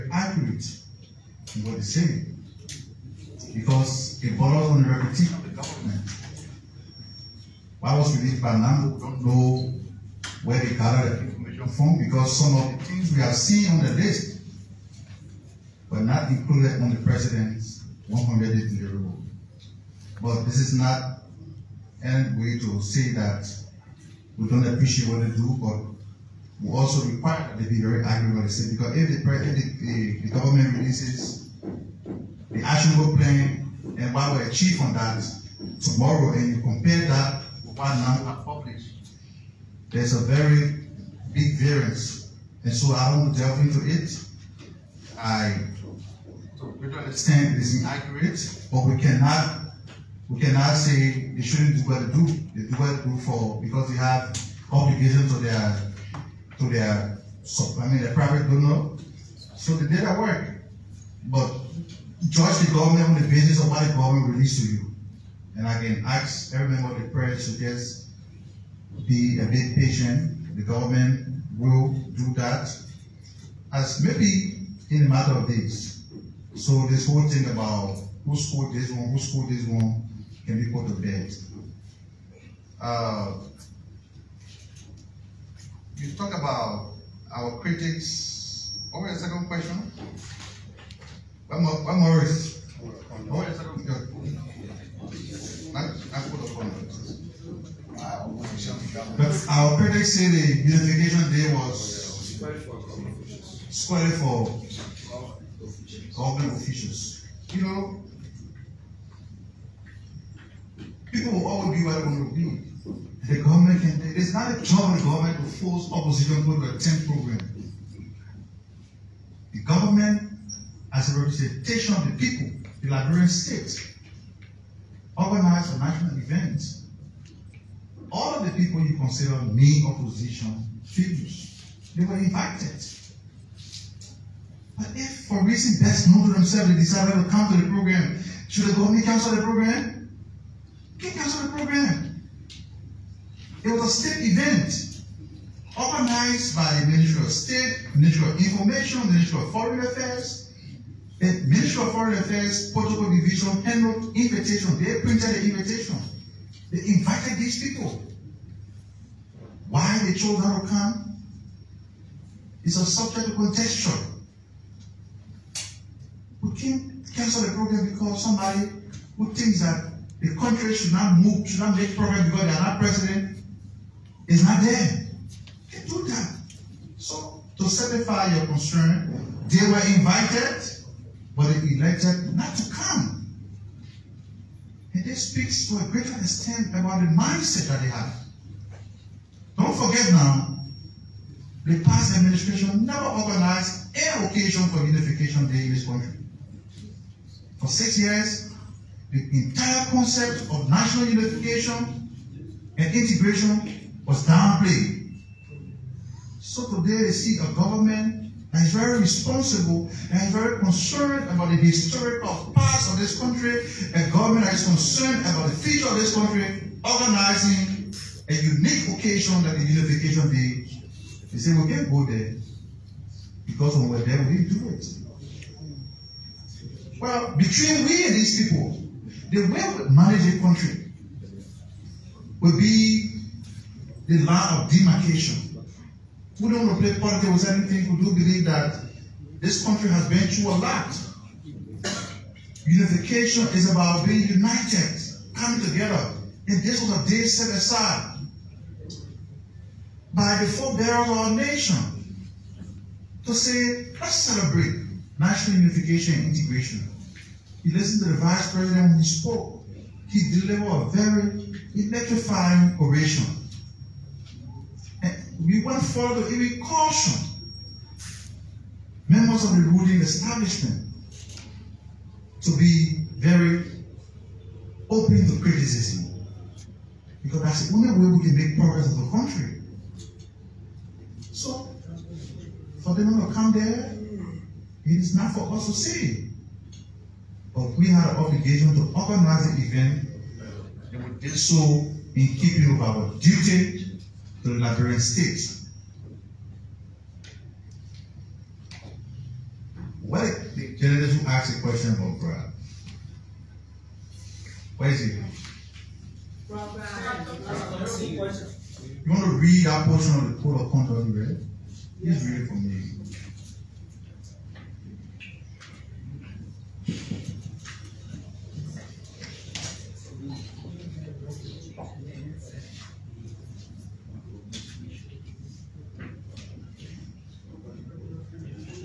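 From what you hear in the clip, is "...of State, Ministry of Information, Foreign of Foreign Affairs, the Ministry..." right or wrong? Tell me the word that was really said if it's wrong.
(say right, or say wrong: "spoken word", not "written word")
wrong: "Ministry", not "Foreign".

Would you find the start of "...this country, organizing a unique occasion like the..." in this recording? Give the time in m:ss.
3:35.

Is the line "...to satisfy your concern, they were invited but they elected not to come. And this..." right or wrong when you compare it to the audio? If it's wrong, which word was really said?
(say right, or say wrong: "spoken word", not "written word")
right.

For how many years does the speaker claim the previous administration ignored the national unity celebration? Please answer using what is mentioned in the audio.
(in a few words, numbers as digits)
6.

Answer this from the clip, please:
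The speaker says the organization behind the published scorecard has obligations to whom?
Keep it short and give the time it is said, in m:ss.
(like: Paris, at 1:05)
their private donor, at 0:58.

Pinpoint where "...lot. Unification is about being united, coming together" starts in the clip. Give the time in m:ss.
4:00.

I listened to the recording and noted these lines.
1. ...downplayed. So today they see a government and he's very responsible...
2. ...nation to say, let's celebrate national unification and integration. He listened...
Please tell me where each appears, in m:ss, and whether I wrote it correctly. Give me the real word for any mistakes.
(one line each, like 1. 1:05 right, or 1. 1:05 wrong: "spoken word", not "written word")
1. 3:24 right
2. 4:11 right.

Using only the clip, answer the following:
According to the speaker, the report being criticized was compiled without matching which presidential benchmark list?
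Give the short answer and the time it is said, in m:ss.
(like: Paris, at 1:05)
100 day deliverable, at 0:18.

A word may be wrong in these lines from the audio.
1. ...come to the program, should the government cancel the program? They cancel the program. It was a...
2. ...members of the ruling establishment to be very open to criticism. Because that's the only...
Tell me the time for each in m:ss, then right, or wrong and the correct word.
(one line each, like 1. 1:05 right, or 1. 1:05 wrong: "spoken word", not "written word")
1. 2:17 right
2. 4:29 right.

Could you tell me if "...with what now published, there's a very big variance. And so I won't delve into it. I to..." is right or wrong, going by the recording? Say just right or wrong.
right.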